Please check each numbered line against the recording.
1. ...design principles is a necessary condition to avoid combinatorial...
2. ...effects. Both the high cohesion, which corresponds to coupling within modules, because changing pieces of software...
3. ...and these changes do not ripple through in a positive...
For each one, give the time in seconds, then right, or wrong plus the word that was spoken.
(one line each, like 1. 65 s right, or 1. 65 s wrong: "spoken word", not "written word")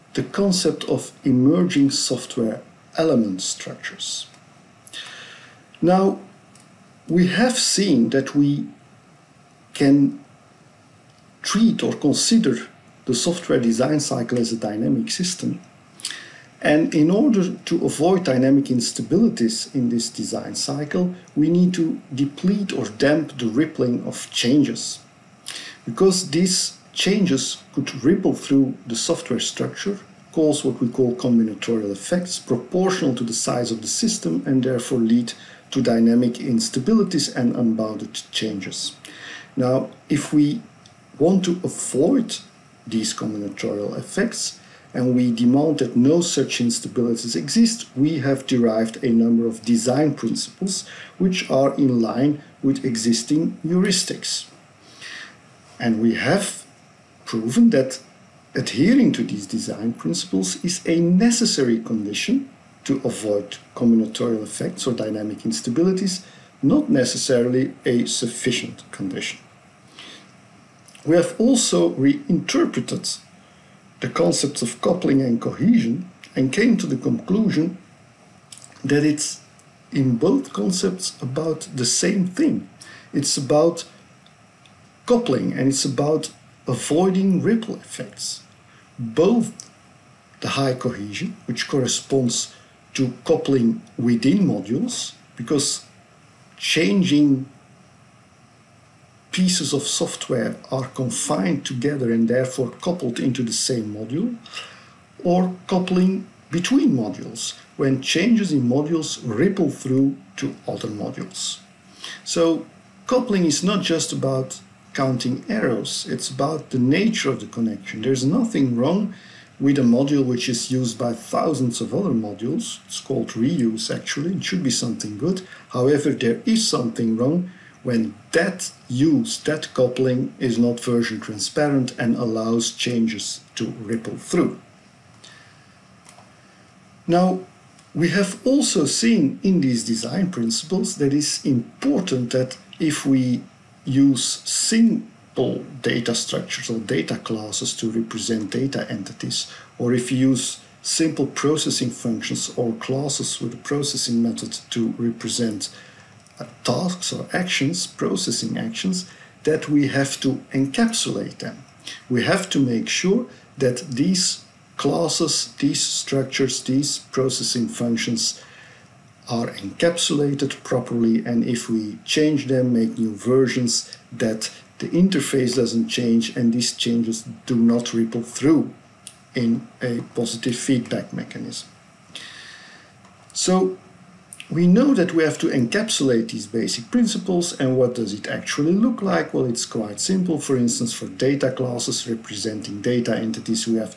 1. 59 s right
2. 87 s right
3. 176 s right.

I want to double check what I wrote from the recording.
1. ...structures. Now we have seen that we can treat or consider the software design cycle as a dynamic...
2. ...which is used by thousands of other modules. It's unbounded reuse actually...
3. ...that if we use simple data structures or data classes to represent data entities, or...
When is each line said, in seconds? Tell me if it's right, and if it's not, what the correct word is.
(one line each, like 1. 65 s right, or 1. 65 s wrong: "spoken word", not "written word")
1. 3 s right
2. 120 s wrong: "called", not "unbounded"
3. 142 s right.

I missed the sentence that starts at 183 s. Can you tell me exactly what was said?
So we know that we have to encapsulate these basic principles and what does it actually look like?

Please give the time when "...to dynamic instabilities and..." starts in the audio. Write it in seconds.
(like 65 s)
35 s.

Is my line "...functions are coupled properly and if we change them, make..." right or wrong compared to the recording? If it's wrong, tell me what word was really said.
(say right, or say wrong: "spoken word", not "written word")
wrong: "encapsulated", not "coupled".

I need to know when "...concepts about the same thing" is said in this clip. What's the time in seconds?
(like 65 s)
80 s.